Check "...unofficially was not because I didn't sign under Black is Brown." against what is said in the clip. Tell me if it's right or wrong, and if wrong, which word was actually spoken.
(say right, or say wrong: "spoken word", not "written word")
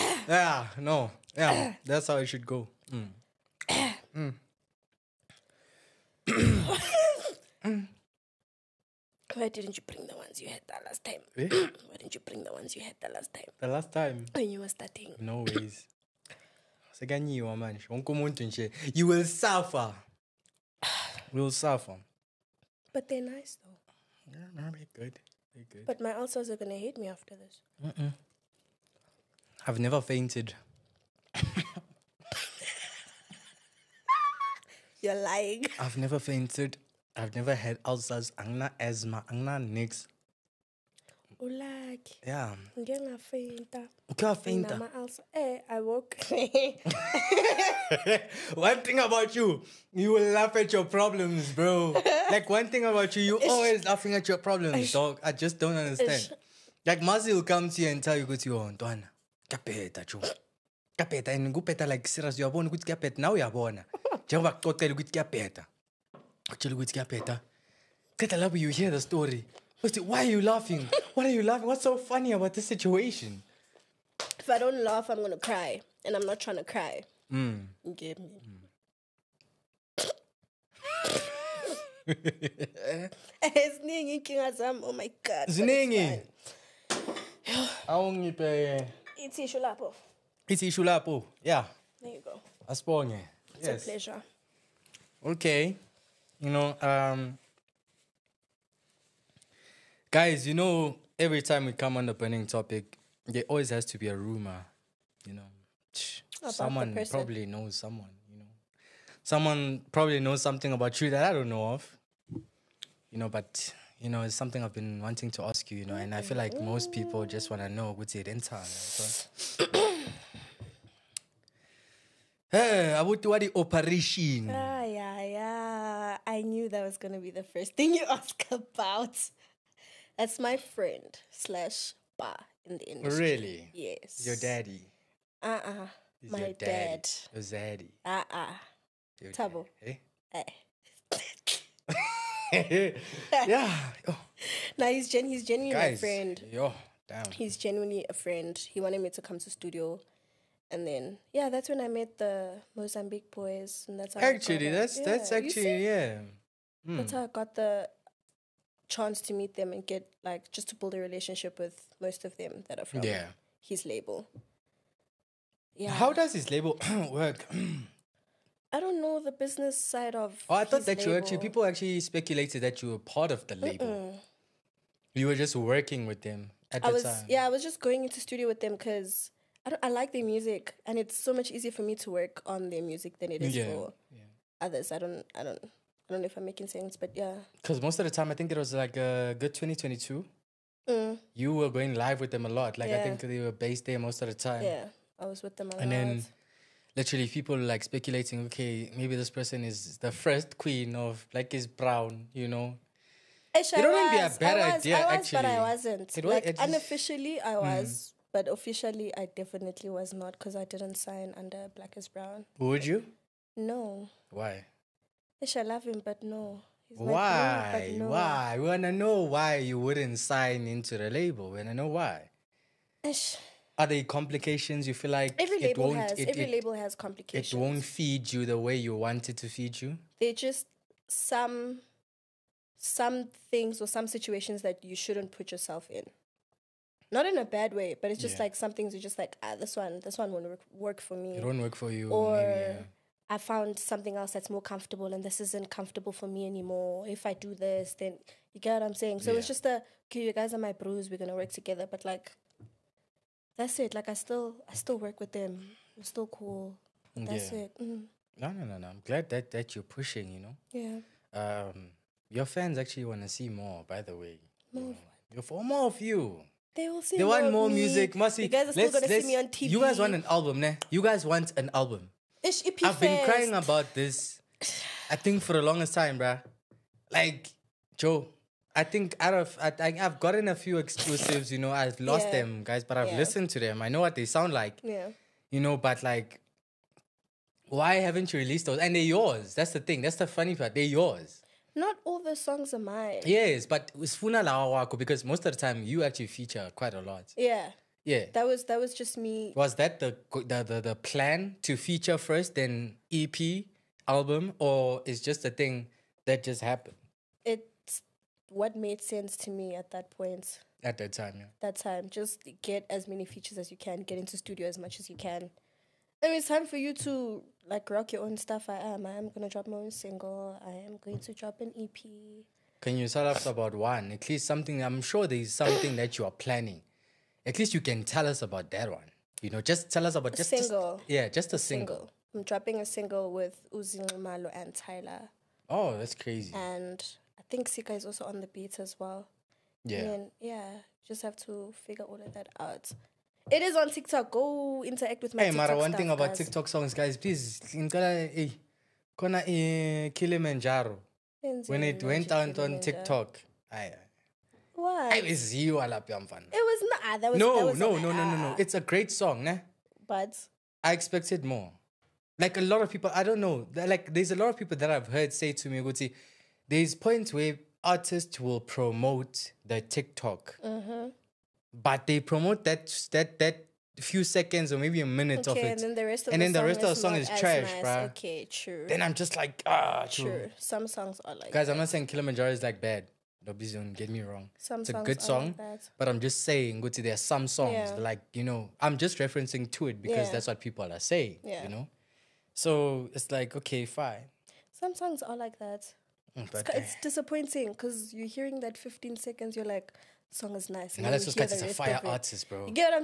wrong: "definitely", not "unofficially".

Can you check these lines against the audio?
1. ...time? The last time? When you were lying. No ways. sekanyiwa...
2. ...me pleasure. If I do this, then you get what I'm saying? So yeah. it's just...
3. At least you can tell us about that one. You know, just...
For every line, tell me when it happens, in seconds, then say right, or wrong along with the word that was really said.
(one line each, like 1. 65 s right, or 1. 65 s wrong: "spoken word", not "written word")
1. 13 s wrong: "starting", not "lying"
2. 246 s wrong: "anymore", not "pleasure"
3. 327 s right.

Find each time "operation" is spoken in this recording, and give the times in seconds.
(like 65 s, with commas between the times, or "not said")
123 s.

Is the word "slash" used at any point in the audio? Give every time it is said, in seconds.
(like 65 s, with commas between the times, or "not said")
131 s.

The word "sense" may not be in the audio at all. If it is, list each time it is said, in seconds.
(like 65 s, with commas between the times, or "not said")
186 s, 309 s.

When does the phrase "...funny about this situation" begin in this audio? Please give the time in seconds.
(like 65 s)
71 s.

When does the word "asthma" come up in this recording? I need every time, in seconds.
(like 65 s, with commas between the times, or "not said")
38 s.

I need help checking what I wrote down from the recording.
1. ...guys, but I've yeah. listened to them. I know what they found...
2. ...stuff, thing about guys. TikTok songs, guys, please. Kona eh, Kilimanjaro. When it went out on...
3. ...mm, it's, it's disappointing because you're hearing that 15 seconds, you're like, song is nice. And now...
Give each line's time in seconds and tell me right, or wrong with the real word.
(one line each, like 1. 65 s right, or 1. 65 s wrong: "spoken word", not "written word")
1. 282 s wrong: "sound", not "found"
2. 345 s right
3. 396 s right.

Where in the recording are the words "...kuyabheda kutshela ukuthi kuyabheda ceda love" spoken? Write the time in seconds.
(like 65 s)
65 s.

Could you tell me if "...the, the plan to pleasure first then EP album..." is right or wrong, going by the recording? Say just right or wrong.
wrong.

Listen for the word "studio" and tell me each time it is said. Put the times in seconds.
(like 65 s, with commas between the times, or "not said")
149 s, 178 s, 314 s.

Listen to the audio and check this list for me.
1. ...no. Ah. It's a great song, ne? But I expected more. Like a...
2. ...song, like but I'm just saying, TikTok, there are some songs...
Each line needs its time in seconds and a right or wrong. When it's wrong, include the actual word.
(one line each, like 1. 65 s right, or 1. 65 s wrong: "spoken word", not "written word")
1. 358 s right
2. 385 s wrong: "Guti", not "TikTok".